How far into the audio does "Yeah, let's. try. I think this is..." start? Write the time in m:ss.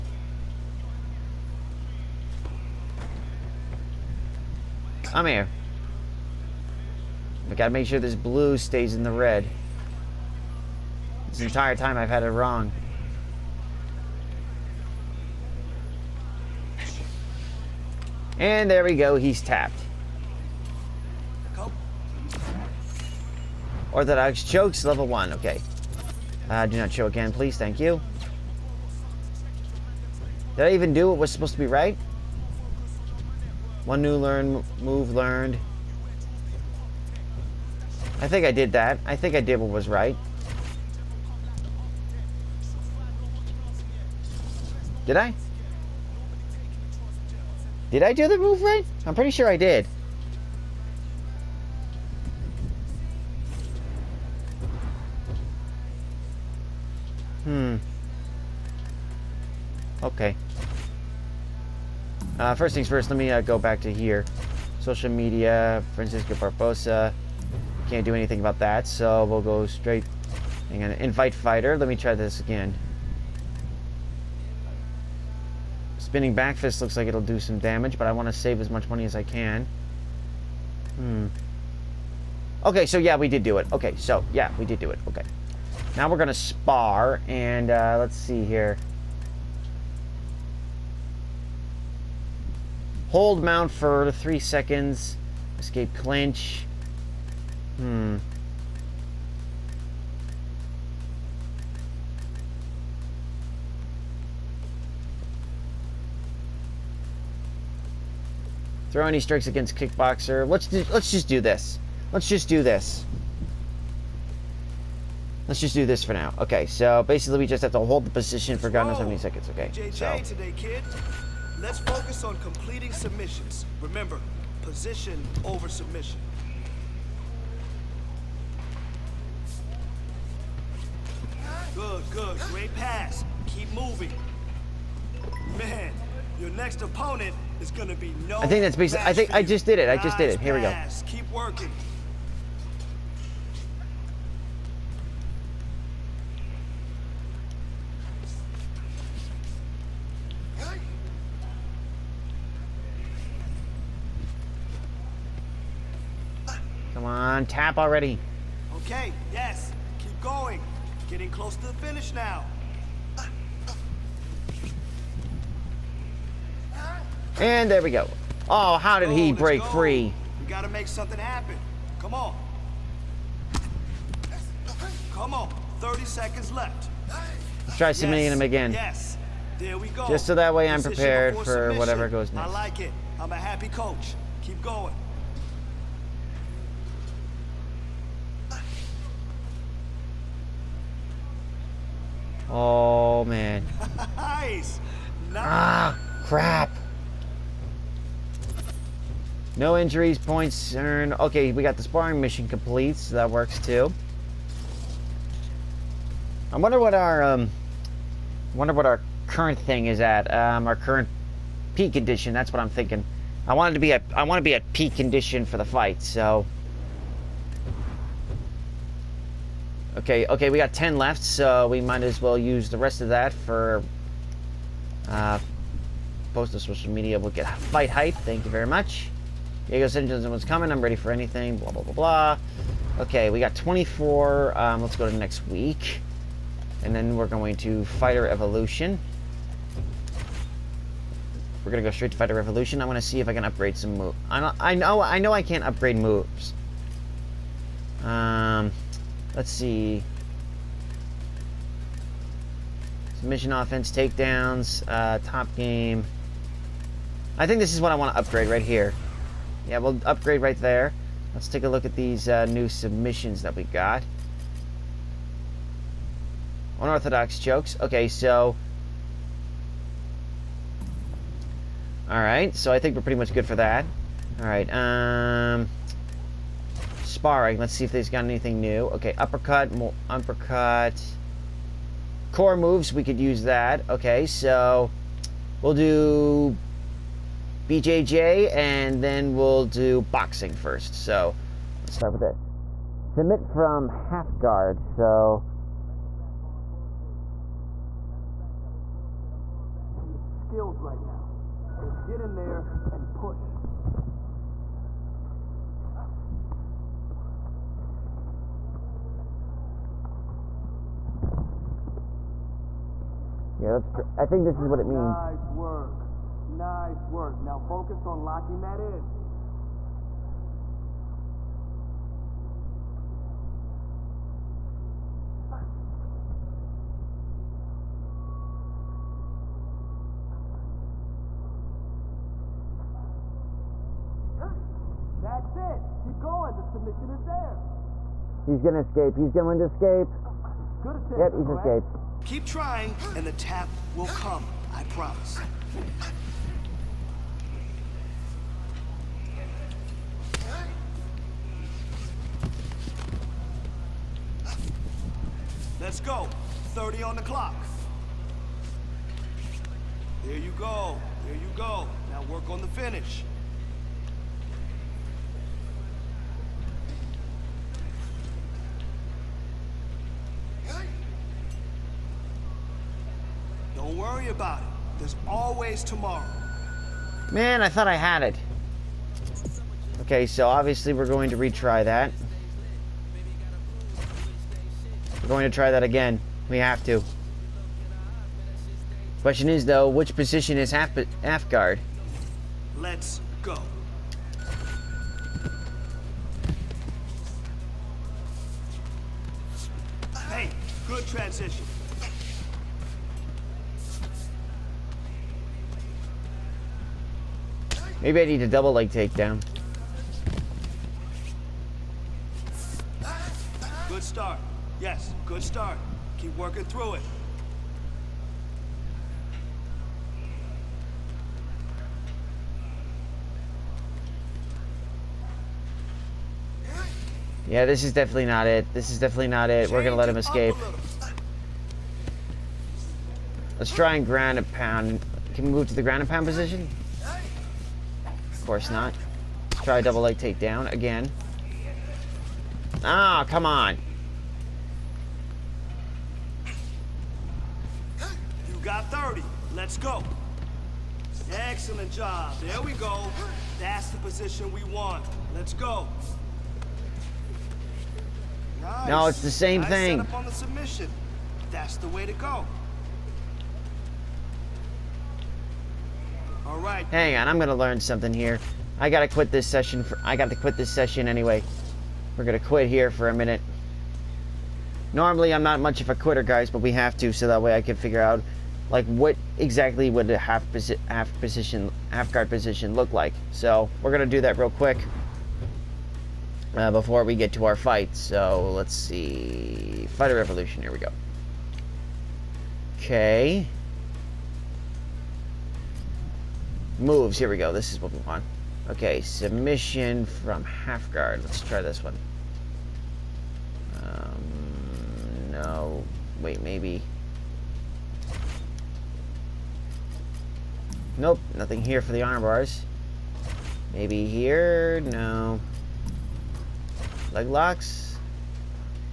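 5:13.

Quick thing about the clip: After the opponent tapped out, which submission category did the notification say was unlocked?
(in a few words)
Orthodox Chokes.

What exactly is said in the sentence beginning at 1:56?
Okay, so basically we just have to hold the position for God knows how many seconds.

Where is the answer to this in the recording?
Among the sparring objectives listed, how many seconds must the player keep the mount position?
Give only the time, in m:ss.
1:34.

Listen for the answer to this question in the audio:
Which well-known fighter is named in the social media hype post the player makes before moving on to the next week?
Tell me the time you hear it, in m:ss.
3:49.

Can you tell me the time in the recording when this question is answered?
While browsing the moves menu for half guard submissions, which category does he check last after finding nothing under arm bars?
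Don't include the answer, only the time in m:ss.
8:37.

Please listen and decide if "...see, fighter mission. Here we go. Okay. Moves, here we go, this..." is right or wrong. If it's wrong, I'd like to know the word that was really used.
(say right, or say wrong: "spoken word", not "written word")
wrong: "revolution", not "mission".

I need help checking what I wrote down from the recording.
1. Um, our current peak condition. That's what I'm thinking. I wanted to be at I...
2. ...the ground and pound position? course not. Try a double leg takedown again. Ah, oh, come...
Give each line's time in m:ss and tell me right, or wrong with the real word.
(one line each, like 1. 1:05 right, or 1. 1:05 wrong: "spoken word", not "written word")
1. 3:30 right
2. 7:15 right.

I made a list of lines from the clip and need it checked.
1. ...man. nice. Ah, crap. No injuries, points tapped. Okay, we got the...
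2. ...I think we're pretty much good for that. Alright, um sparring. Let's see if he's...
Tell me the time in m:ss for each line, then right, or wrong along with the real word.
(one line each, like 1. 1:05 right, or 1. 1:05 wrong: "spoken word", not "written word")
1. 3:13 wrong: "earned", not "tapped"
2. 4:32 right.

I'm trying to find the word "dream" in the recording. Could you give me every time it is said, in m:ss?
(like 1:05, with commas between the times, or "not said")
not said.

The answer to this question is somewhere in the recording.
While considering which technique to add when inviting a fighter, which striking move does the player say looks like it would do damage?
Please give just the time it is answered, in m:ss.
1:15.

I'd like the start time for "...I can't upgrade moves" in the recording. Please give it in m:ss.
4:05.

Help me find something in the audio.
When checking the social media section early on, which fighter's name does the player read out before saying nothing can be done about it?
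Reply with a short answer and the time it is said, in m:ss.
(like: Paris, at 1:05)
Francisco Barbosa, at 1:05.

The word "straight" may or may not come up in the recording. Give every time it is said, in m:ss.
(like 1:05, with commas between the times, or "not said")
1:09, 4:01.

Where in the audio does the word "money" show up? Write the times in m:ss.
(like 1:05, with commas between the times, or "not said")
1:18.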